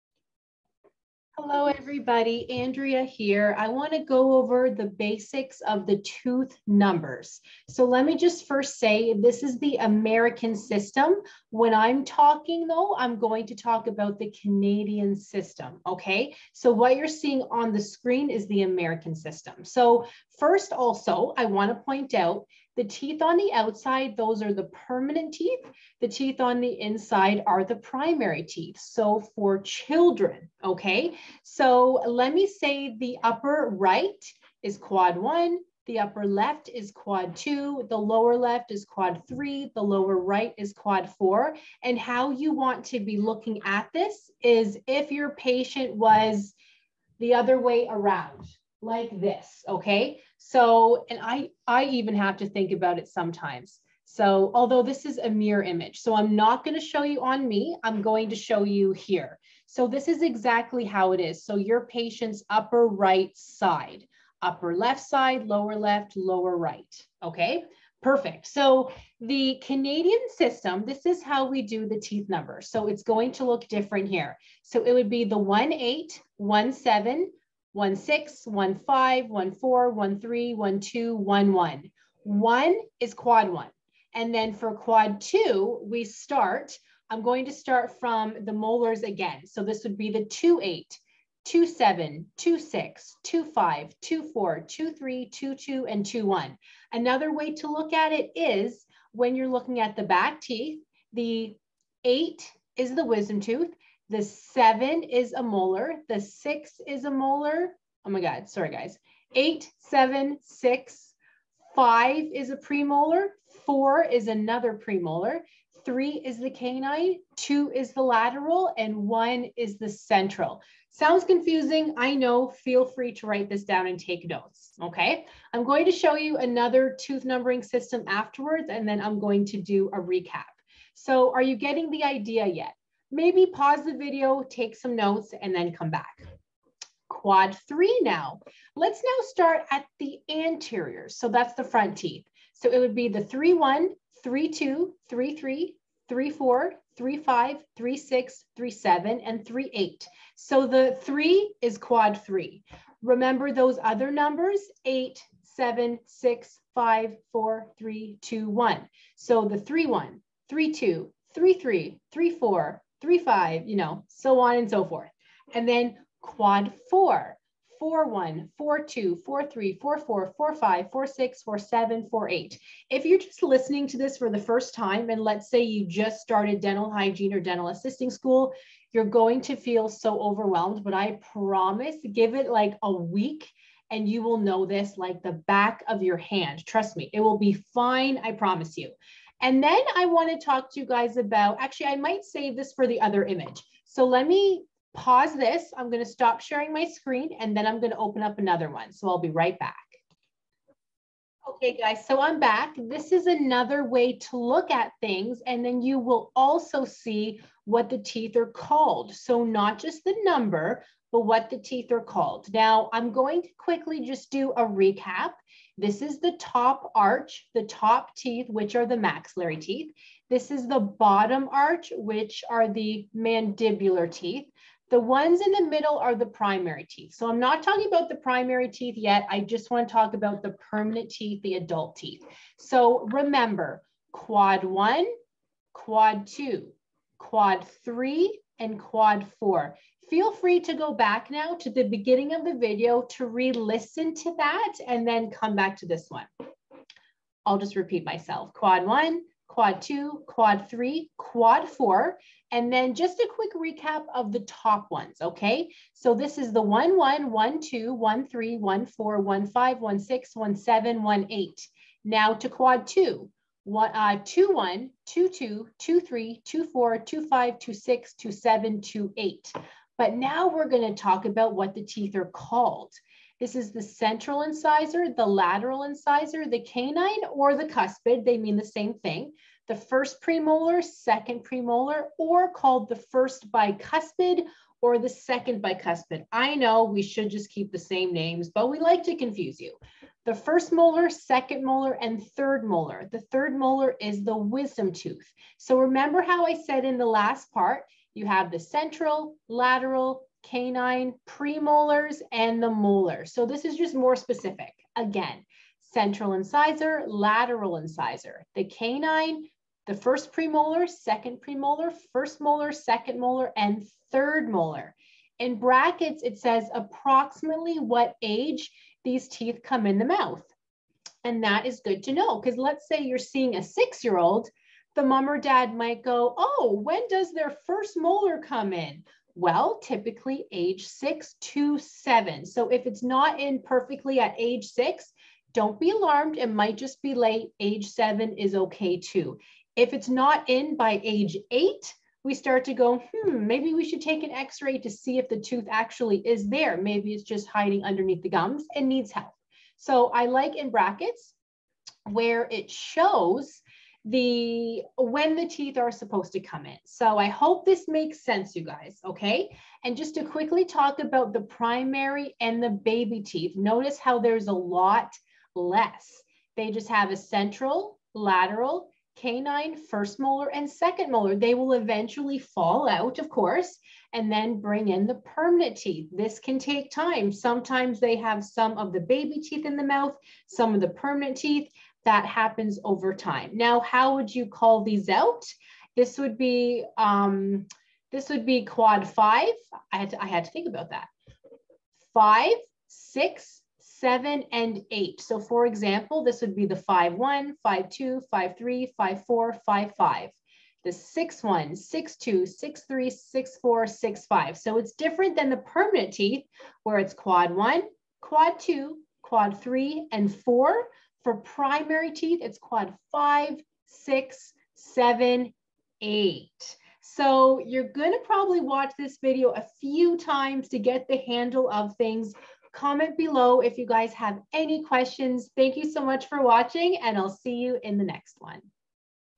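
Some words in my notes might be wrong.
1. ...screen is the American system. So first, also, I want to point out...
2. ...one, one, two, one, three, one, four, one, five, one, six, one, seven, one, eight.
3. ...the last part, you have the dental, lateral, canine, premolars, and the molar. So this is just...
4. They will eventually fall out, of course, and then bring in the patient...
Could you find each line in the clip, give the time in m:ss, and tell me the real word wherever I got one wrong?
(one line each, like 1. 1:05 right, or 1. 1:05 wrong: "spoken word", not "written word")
1. 0:17 right
2. 4:16 right
3. 4:56 wrong: "central", not "dental"
4. 6:11 wrong: "permanent", not "patient".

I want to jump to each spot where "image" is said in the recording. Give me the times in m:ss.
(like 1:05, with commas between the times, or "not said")
0:55, 3:13.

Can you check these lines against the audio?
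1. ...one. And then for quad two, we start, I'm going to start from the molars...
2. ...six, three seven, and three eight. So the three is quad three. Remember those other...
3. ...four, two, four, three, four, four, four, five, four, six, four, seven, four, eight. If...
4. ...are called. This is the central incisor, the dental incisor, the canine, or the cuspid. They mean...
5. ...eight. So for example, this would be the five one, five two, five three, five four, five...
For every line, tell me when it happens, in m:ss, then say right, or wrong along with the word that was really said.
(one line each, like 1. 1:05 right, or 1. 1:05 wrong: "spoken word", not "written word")
1. 1:23 right
2. 2:27 right
3. 2:48 right
4. 4:32 wrong: "lateral", not "dental"
5. 6:34 right.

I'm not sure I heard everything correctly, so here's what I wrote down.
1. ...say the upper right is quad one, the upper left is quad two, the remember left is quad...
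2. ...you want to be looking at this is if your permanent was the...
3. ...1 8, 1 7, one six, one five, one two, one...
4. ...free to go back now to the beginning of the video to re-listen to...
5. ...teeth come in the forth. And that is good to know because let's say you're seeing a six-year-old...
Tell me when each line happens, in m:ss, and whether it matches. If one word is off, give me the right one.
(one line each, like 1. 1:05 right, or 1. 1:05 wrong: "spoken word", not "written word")
1. 0:32 wrong: "lower", not "remember"
2. 0:42 wrong: "patient", not "permanent"
3. 1:15 wrong: "four", not "two"
4. 4:00 right
5. 5:19 wrong: "mouth", not "forth".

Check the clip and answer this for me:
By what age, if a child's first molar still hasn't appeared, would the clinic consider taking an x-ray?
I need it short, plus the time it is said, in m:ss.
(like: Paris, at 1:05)
8, at 5:41.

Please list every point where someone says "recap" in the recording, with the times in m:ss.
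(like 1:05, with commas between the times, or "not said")
2:10, 3:34, 4:13.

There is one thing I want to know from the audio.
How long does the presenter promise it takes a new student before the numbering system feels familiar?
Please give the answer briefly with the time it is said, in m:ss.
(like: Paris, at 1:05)
a week, at 3:02.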